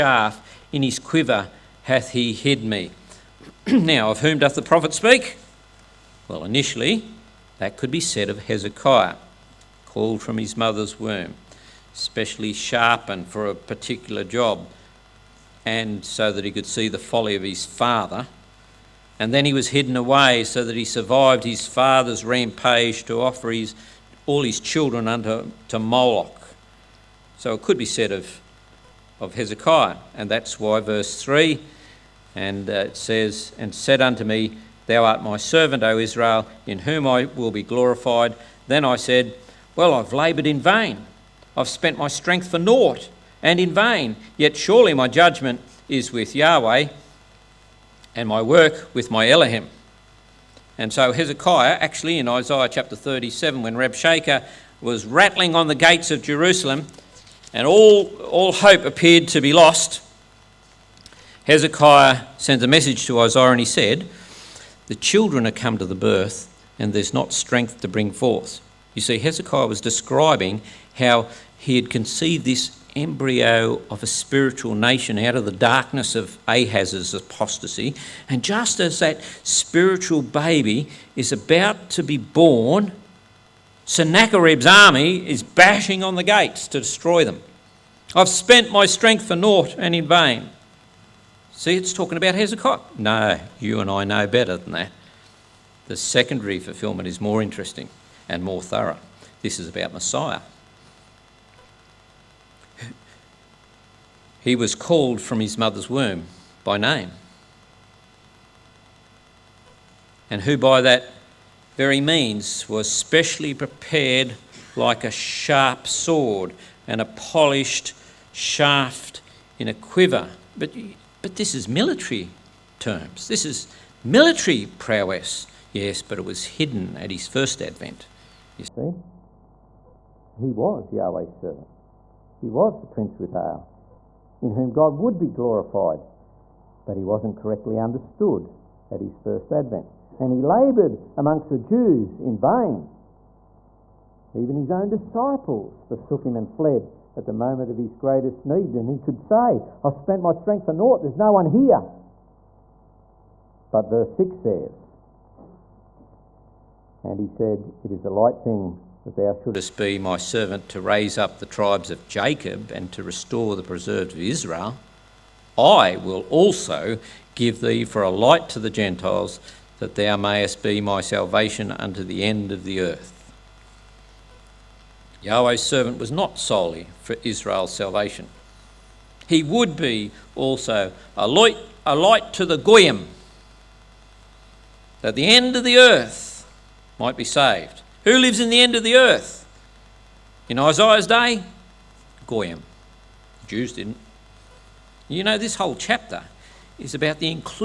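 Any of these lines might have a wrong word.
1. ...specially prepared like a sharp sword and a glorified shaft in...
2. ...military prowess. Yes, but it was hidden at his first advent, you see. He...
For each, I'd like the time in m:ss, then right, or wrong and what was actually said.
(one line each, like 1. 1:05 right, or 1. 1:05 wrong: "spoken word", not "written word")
1. 1:52 wrong: "polished", not "glorified"
2. 2:04 right.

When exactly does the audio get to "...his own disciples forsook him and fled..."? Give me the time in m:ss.
2:24.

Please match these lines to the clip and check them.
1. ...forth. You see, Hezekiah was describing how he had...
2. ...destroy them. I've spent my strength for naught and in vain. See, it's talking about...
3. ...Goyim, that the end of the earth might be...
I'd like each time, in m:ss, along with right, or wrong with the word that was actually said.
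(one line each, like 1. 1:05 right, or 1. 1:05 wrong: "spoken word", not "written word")
1. 1:08 right
2. 1:26 right
3. 3:02 right.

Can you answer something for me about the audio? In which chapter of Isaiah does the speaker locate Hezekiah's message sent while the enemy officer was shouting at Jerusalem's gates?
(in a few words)
Chapter 37.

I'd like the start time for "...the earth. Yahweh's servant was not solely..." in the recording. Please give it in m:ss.
2:52.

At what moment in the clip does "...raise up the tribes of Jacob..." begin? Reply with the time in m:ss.
2:40.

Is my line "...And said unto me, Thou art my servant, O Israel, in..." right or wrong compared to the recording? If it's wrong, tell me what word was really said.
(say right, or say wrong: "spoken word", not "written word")
right.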